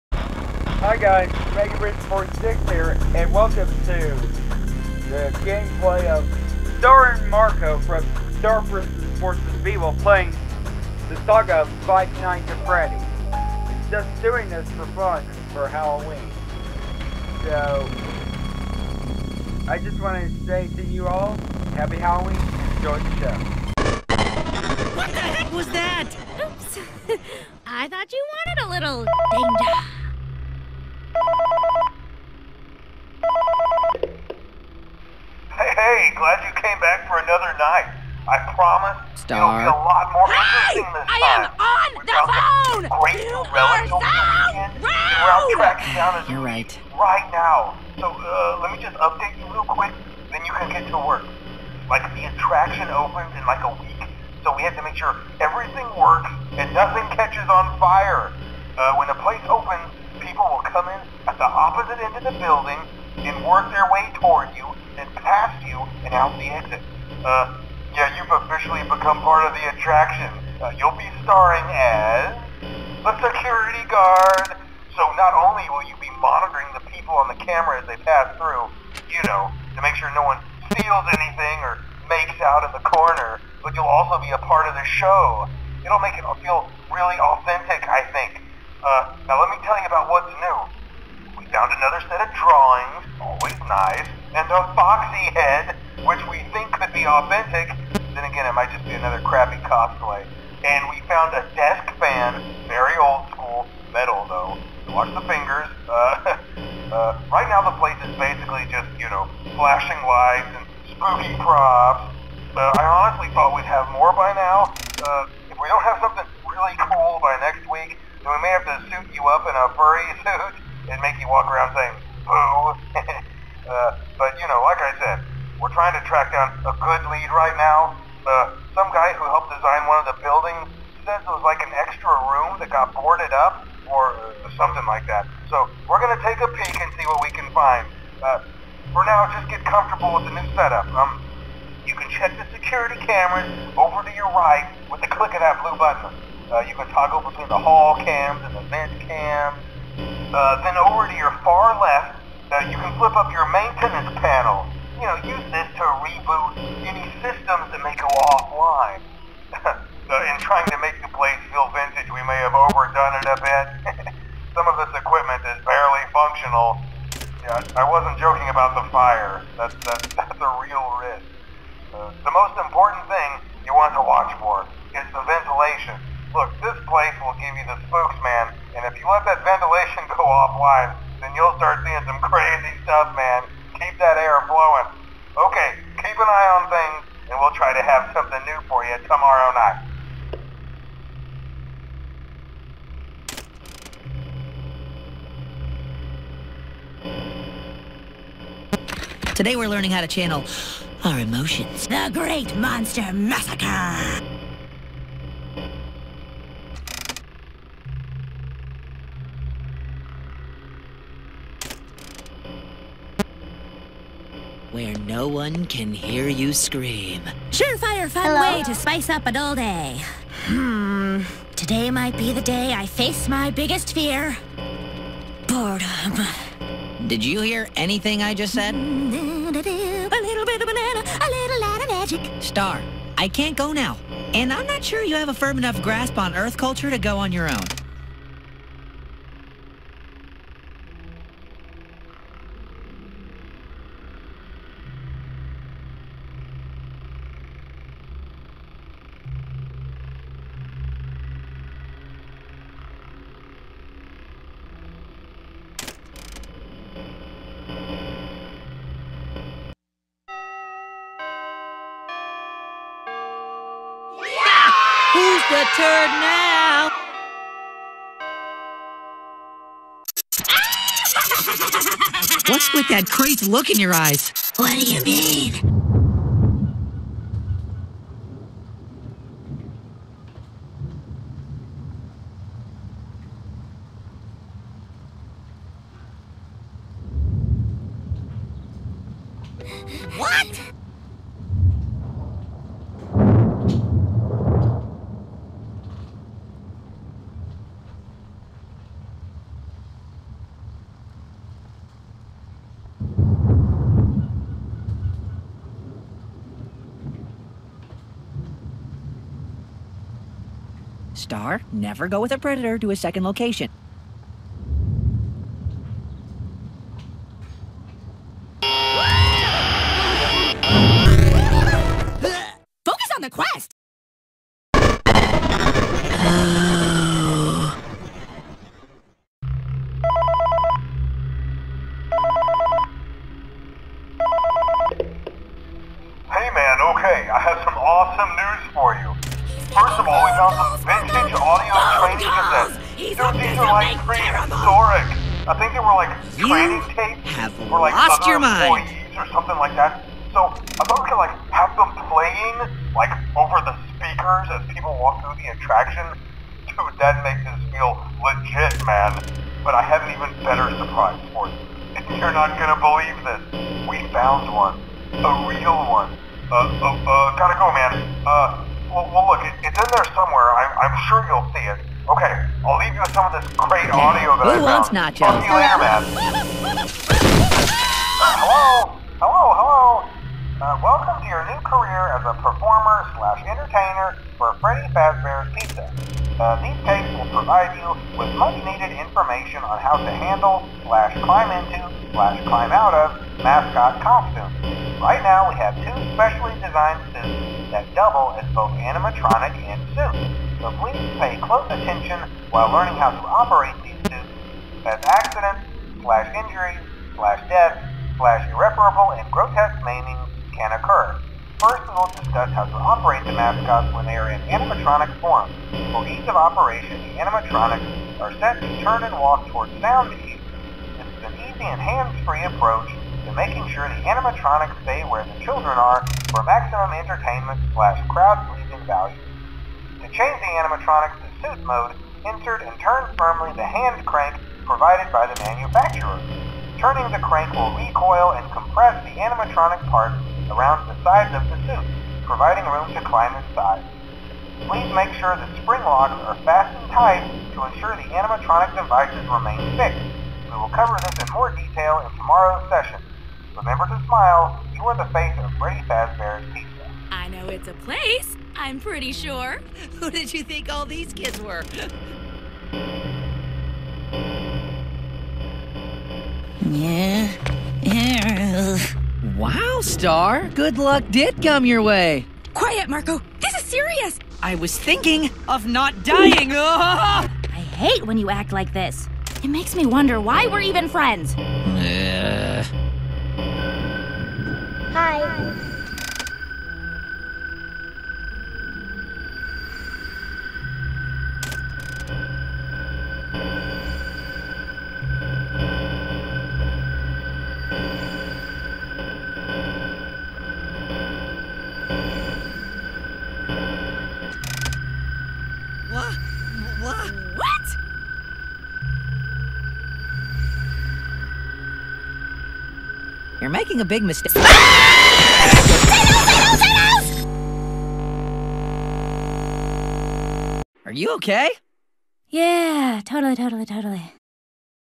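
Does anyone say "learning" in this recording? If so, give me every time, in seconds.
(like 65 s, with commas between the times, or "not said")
199 s, 402 s.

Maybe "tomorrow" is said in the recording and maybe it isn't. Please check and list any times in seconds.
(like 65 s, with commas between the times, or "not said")
189 s, 452 s.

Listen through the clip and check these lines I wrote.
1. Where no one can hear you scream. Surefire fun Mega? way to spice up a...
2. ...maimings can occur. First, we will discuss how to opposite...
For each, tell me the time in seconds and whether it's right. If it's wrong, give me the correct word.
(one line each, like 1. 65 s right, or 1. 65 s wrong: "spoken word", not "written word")
1. 214 s wrong: "Hello", not "Mega"
2. 409 s wrong: "operate", not "opposite".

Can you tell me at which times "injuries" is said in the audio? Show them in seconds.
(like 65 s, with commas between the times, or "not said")
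406 s.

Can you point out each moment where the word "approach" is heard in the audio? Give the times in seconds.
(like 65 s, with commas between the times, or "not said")
422 s.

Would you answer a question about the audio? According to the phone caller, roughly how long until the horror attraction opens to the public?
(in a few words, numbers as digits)
a week.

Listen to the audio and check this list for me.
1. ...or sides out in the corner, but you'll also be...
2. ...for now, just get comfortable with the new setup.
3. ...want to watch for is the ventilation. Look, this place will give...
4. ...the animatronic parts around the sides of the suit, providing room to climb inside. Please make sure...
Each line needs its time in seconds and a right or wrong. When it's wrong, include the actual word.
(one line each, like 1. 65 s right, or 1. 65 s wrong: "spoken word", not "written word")
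1. 81 s wrong: "makes", not "sides"
2. 138 s right
3. 173 s right
4. 439 s right.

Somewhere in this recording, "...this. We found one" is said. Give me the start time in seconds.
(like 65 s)
363 s.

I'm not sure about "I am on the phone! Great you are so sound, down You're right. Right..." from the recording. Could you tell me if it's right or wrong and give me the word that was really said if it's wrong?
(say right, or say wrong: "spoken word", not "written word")
wrong: "weekend", not "sound".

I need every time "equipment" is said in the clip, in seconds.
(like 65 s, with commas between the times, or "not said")
164 s.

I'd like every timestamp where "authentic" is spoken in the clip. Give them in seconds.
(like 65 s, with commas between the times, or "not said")
87 s, 97 s.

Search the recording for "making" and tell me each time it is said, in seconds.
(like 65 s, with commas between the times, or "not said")
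423 s, 513 s.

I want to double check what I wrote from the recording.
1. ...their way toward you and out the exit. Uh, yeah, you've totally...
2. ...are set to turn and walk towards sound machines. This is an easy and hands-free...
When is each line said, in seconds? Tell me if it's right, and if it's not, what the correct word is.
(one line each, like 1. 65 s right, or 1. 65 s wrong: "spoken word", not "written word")
1. 63 s wrong: "officially", not "totally"
2. 418 s right.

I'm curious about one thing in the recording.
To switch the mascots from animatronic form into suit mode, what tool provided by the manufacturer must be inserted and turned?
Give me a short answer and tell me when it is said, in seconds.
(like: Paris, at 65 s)
hand crank, at 433 s.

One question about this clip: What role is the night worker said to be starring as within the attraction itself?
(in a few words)
security guard.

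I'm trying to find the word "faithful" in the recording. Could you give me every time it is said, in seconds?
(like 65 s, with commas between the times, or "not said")
not said.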